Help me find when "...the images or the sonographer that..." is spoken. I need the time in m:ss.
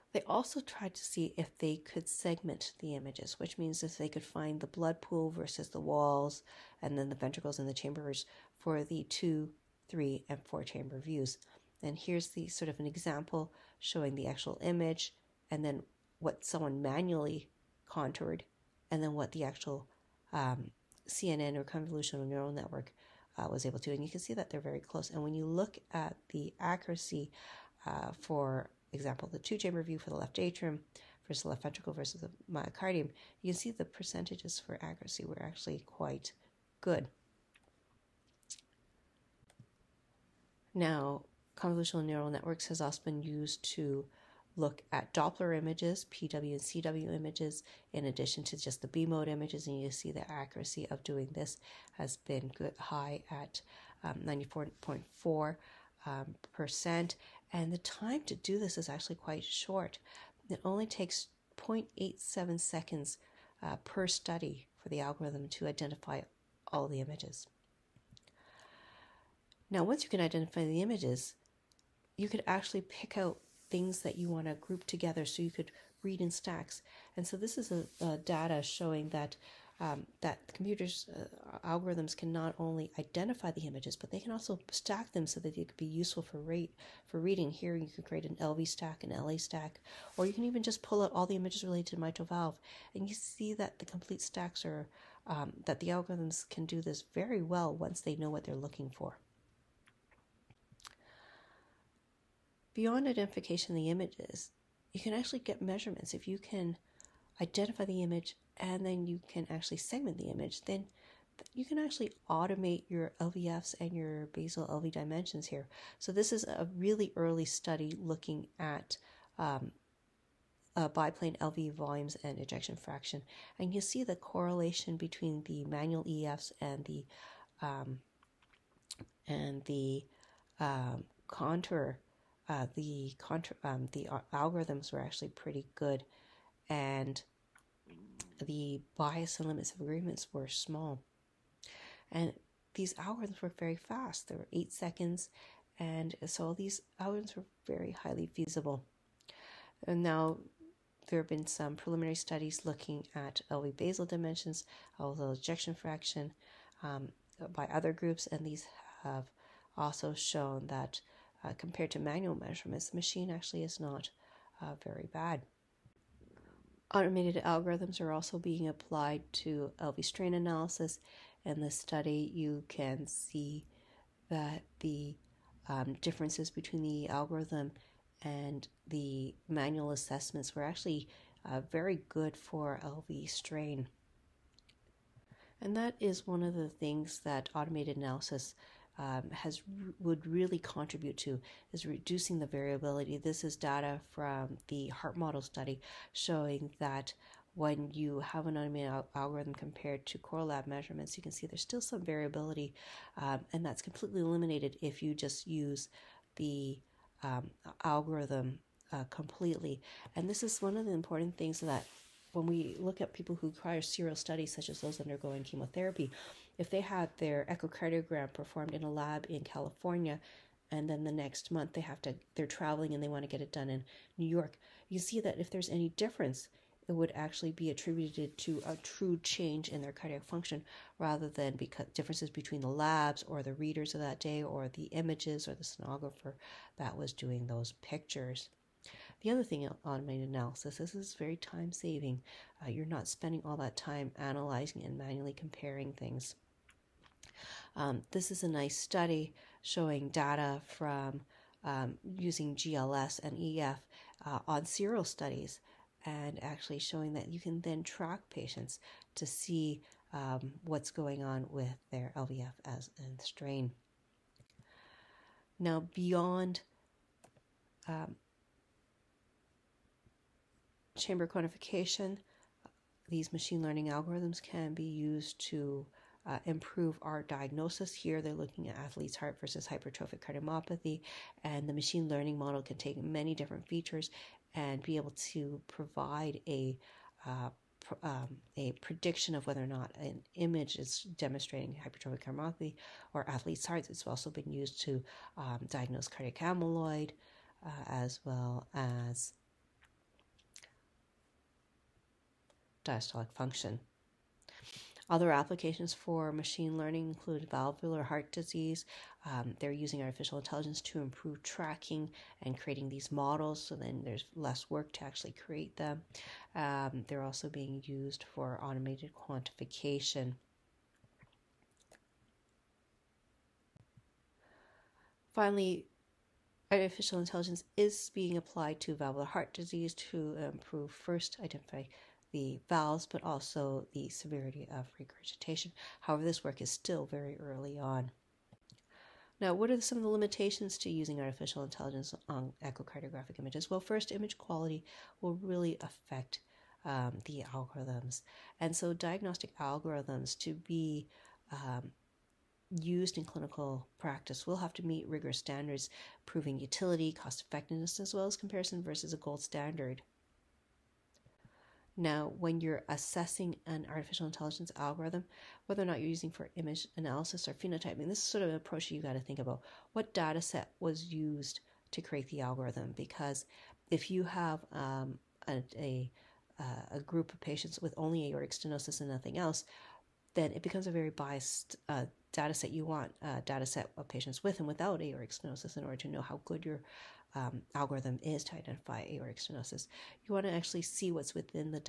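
3:54.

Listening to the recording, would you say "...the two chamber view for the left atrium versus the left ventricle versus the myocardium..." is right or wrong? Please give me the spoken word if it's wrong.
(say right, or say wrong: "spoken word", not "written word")
right.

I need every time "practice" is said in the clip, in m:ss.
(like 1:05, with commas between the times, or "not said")
5:53.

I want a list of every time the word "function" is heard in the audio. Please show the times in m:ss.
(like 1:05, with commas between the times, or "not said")
3:50, 5:03.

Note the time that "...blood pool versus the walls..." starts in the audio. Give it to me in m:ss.
0:04.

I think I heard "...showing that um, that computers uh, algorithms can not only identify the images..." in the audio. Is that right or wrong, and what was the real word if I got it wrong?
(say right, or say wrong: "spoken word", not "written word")
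right.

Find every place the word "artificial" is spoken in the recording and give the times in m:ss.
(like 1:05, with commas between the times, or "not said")
5:10, 5:26, 5:41, 6:03.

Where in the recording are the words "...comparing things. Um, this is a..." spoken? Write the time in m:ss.
4:05.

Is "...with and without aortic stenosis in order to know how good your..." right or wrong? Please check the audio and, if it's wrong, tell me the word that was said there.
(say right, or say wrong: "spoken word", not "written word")
right.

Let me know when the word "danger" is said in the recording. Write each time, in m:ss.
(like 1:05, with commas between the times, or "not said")
not said.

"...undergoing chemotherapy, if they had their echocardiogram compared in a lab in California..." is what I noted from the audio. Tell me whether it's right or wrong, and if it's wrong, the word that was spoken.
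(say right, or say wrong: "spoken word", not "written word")
wrong: "performed", not "compared".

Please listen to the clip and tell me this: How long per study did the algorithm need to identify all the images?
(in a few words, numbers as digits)
0.87 seconds.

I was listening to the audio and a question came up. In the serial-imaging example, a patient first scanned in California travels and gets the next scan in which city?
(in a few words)
New York.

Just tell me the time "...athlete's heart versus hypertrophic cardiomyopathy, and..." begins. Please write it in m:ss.
4:38.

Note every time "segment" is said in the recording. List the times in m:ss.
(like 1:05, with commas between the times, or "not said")
0:02, 1:49.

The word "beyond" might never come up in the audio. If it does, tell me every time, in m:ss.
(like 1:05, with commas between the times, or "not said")
1:42, 4:25.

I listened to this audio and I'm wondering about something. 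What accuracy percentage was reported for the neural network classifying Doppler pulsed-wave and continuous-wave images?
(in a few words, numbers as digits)
94.4%.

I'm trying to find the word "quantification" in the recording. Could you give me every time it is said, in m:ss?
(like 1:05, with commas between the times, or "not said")
4:31, 5:19.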